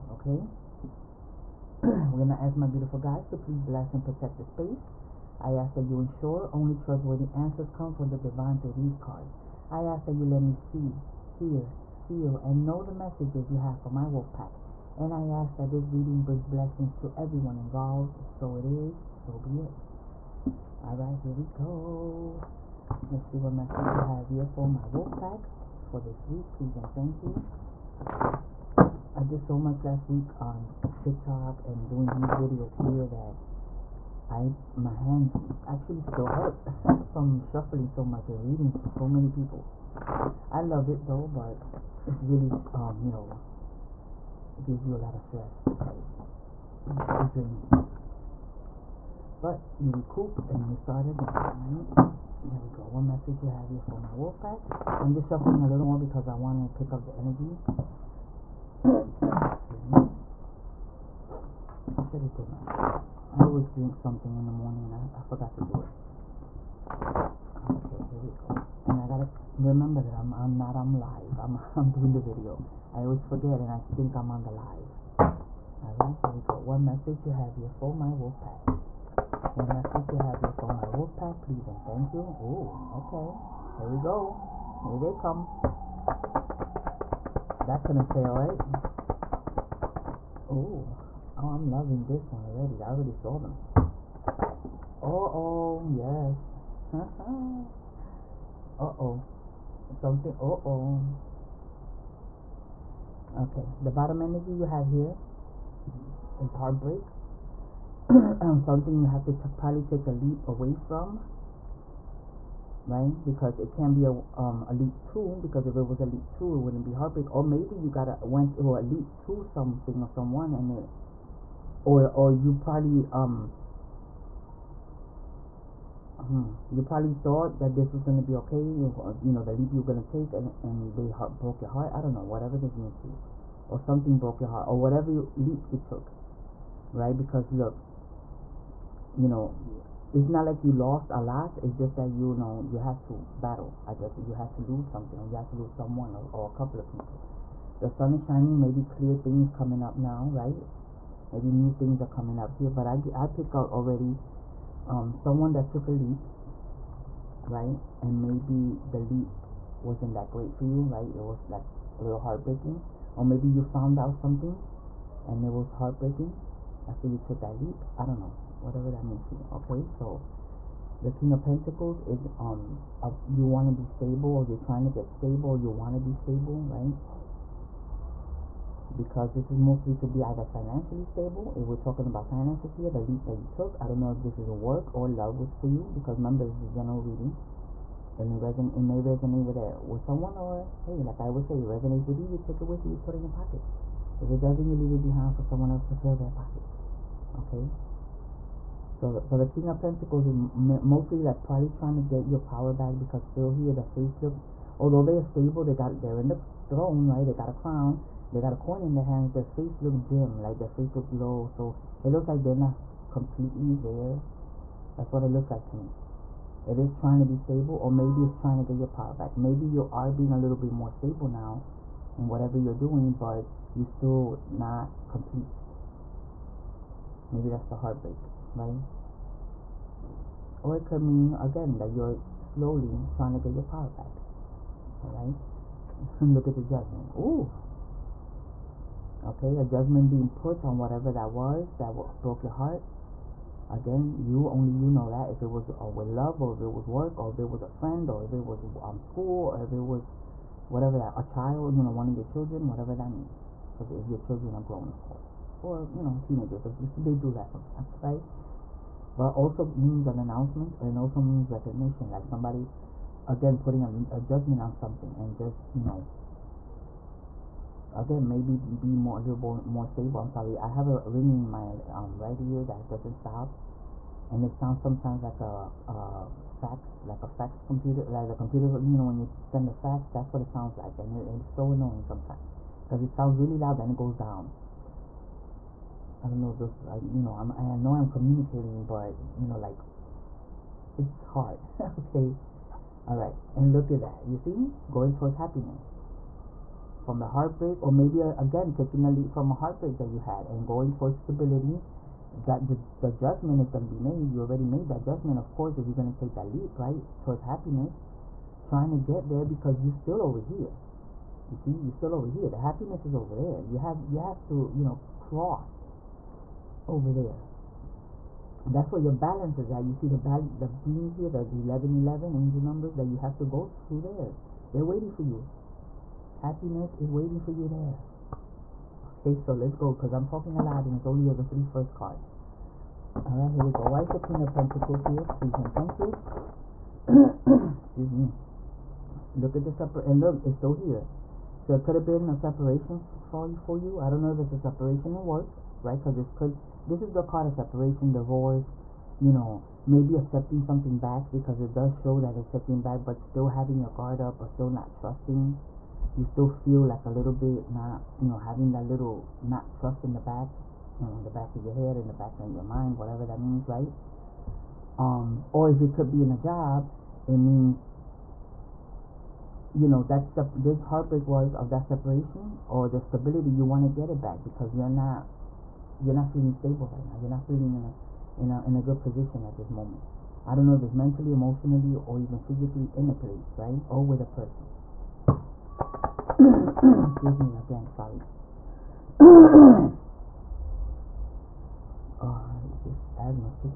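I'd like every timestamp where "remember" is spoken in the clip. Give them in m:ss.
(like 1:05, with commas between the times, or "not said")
1:09, 3:06.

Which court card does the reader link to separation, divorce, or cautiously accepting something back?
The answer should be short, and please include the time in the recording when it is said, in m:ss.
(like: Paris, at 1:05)
Queen of Pentacles, at 5:34.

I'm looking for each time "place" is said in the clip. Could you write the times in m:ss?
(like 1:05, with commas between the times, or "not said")
6:23.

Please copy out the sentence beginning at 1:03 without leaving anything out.
I always drink something in the morning and I, I forgot to do it.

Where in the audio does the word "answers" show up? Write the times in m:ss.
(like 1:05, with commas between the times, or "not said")
0:07.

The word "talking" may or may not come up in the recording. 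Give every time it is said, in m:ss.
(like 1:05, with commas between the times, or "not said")
3:01, 5:30.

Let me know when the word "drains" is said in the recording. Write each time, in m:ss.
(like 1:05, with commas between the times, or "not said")
0:47.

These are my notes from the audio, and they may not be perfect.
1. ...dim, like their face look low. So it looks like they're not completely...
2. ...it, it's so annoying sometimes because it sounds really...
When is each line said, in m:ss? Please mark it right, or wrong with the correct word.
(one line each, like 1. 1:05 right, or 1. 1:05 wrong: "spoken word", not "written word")
1. 3:30 right
2. 4:41 right.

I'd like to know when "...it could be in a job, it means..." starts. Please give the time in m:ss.
6:05.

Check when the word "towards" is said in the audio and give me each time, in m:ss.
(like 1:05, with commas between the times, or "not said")
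4:55, 5:00, 5:07.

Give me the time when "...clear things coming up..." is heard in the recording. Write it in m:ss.
2:28.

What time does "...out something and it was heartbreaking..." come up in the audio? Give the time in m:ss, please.
2:43.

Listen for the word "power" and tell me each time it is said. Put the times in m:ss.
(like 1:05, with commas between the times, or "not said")
3:22, 3:38, 3:53.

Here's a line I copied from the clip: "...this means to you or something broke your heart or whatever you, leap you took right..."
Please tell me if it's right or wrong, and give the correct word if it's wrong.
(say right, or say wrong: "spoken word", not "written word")
right.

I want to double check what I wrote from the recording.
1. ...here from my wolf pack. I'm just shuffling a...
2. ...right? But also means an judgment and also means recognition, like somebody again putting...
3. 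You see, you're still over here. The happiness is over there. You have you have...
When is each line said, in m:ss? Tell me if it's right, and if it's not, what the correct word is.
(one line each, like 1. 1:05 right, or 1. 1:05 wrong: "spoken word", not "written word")
1. 0:53 right
2. 4:18 wrong: "announcement", not "judgment"
3. 5:11 right.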